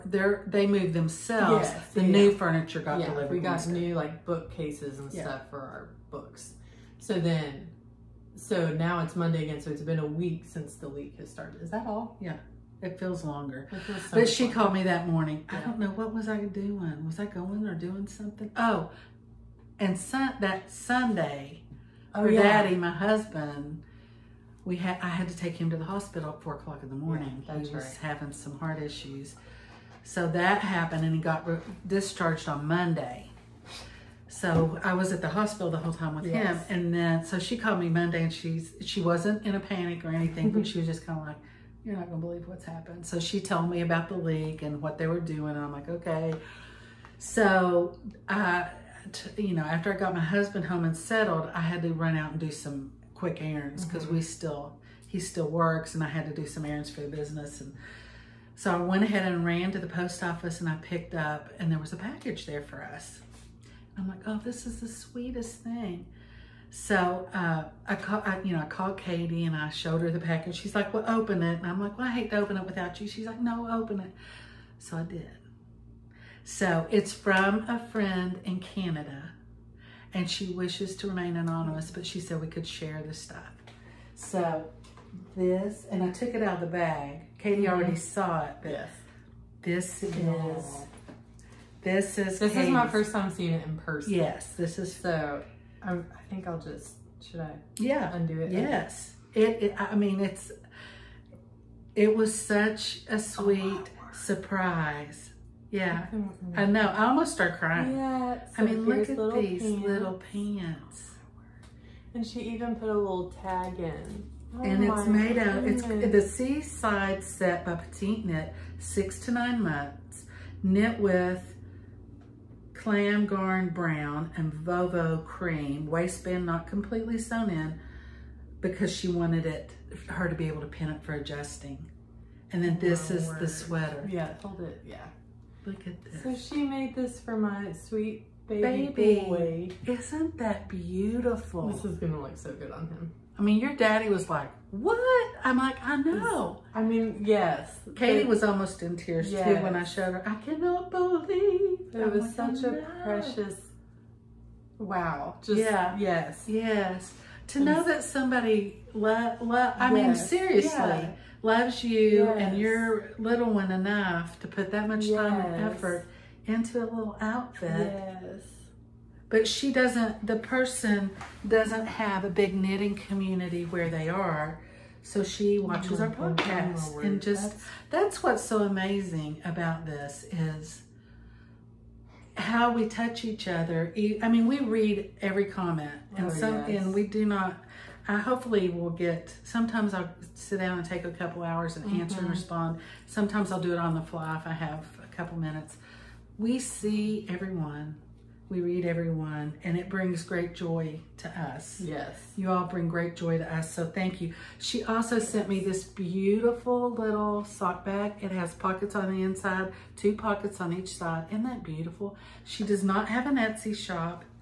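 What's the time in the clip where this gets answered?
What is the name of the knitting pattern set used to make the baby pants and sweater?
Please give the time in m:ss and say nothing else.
1:56.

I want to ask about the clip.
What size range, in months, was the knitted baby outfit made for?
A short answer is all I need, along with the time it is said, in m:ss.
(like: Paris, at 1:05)
6 to 9 months, at 1:58.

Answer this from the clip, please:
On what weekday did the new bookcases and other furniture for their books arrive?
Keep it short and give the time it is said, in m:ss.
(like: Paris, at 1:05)
Wednesday, at 0:03.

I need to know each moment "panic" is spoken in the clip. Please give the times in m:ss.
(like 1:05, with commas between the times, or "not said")
0:39.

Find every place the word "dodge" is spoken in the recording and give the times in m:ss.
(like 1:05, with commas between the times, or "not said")
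not said.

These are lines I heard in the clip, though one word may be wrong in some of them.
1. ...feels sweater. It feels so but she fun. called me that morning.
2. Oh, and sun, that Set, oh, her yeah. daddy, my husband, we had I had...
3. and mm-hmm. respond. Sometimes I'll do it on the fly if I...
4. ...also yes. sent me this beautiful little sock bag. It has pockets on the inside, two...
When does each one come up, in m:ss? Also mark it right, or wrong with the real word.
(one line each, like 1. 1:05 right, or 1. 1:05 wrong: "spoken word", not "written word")
1. 0:12 wrong: "longer", not "sweater"
2. 0:18 wrong: "Sunday", not "Set"
3. 3:12 right
4. 3:24 right.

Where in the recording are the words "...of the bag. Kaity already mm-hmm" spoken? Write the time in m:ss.
1:26.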